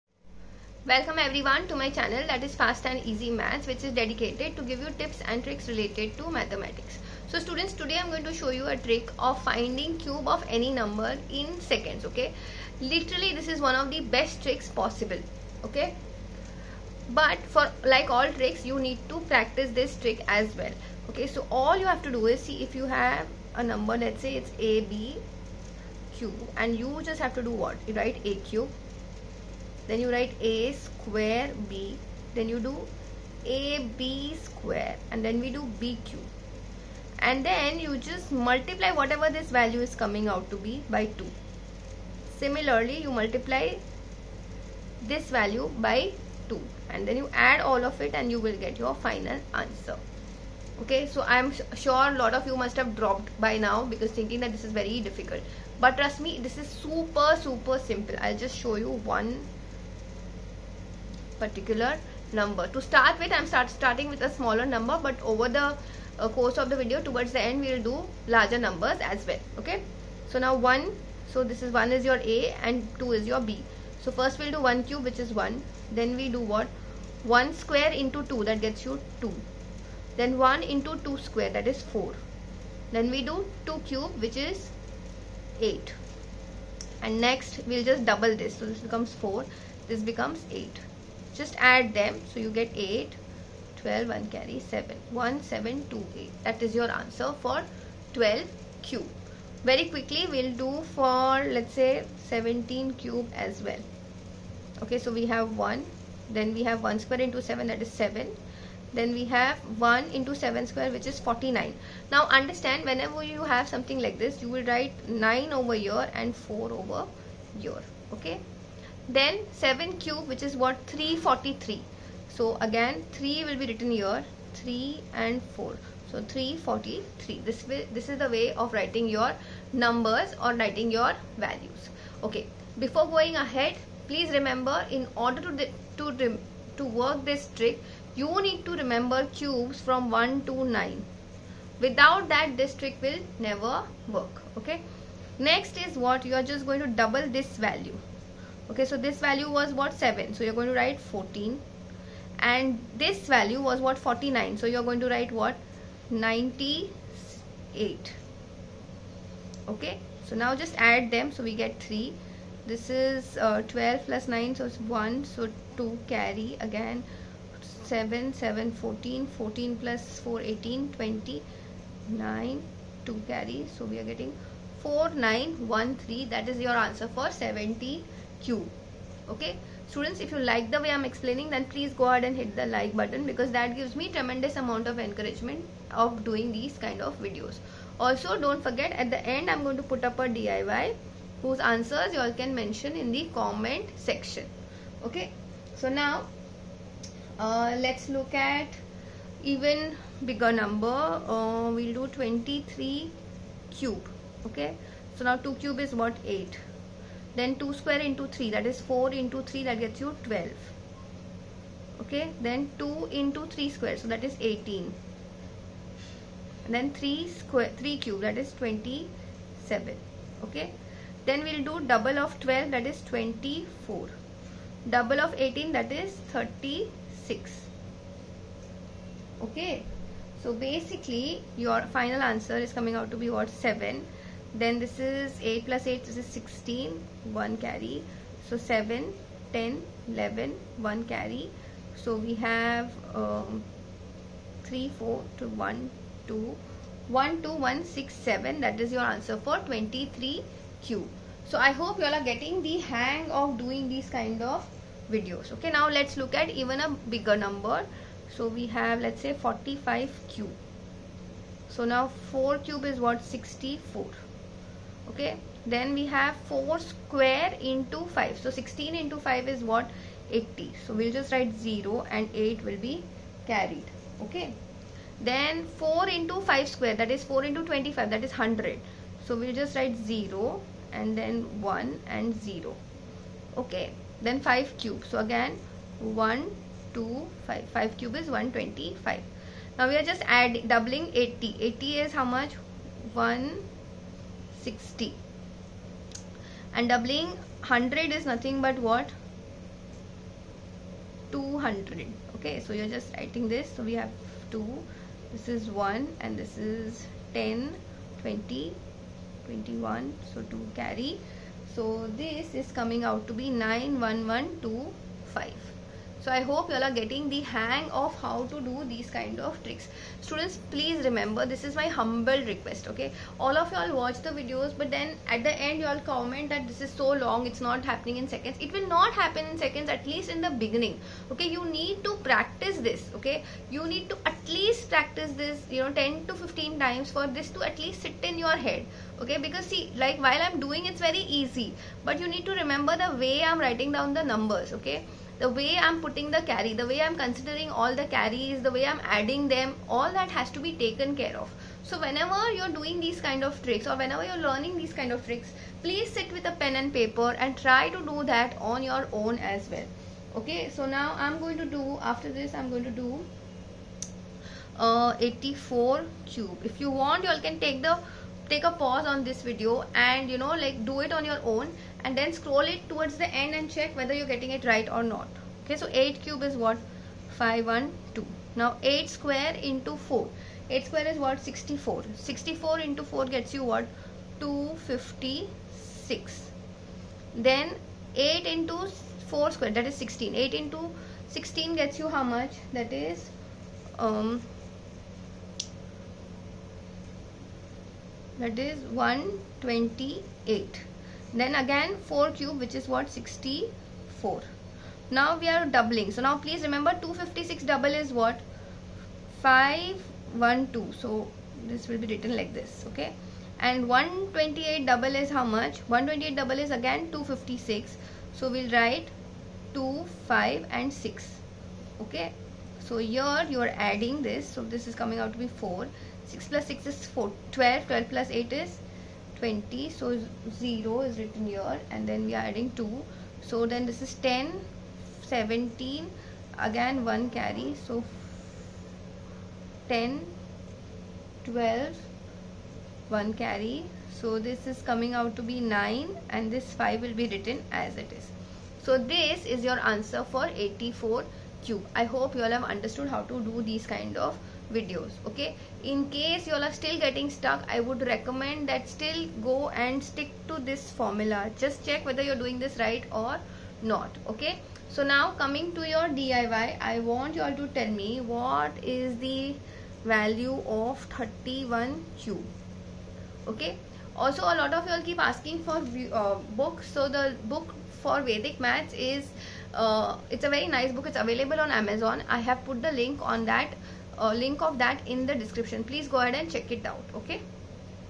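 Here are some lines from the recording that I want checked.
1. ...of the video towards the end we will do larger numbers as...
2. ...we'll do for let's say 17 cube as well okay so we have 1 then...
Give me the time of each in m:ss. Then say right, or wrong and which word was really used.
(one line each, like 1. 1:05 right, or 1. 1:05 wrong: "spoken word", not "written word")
1. 1:06 right
2. 1:40 right.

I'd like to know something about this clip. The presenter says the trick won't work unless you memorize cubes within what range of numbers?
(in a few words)
1 to 9.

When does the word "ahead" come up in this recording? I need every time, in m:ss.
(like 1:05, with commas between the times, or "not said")
2:13, 3:02, 8:06.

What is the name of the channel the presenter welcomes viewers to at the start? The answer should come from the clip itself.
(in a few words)
Fast and Easy Maths.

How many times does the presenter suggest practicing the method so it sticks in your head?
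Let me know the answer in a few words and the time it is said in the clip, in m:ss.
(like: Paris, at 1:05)
10 to 15, at 5:36.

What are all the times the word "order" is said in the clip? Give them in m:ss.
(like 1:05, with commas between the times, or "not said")
2:15.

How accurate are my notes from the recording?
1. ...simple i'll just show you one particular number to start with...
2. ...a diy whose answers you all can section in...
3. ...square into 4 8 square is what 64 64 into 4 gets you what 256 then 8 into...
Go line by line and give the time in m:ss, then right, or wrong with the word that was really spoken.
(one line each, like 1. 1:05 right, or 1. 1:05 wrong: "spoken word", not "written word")
1. 0:57 right
2. 3:10 wrong: "mention", not "section"
3. 6:19 right.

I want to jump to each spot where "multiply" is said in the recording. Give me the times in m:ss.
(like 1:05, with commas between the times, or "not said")
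0:38, 0:43.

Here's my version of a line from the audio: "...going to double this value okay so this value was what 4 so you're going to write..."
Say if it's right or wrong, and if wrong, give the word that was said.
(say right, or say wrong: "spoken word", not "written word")
wrong: "7", not "4".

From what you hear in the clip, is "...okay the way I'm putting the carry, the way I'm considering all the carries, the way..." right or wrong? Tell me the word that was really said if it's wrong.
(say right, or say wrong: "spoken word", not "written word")
right.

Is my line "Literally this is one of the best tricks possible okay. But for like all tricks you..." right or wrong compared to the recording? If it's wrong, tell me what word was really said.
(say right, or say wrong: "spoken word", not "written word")
right.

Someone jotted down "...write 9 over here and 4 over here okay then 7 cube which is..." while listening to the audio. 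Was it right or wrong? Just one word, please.
right.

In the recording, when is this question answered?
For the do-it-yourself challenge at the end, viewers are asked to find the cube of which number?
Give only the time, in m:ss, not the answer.
7:51.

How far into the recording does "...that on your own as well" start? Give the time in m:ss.
5:58.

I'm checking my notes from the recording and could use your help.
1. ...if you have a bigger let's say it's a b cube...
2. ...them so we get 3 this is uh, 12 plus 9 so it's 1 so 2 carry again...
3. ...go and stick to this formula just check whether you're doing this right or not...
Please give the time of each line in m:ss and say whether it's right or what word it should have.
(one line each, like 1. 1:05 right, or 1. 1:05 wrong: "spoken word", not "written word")
1. 0:22 wrong: "number", not "bigger"
2. 2:41 right
3. 7:39 right.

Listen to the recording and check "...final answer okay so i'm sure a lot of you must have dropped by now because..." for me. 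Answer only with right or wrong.
right.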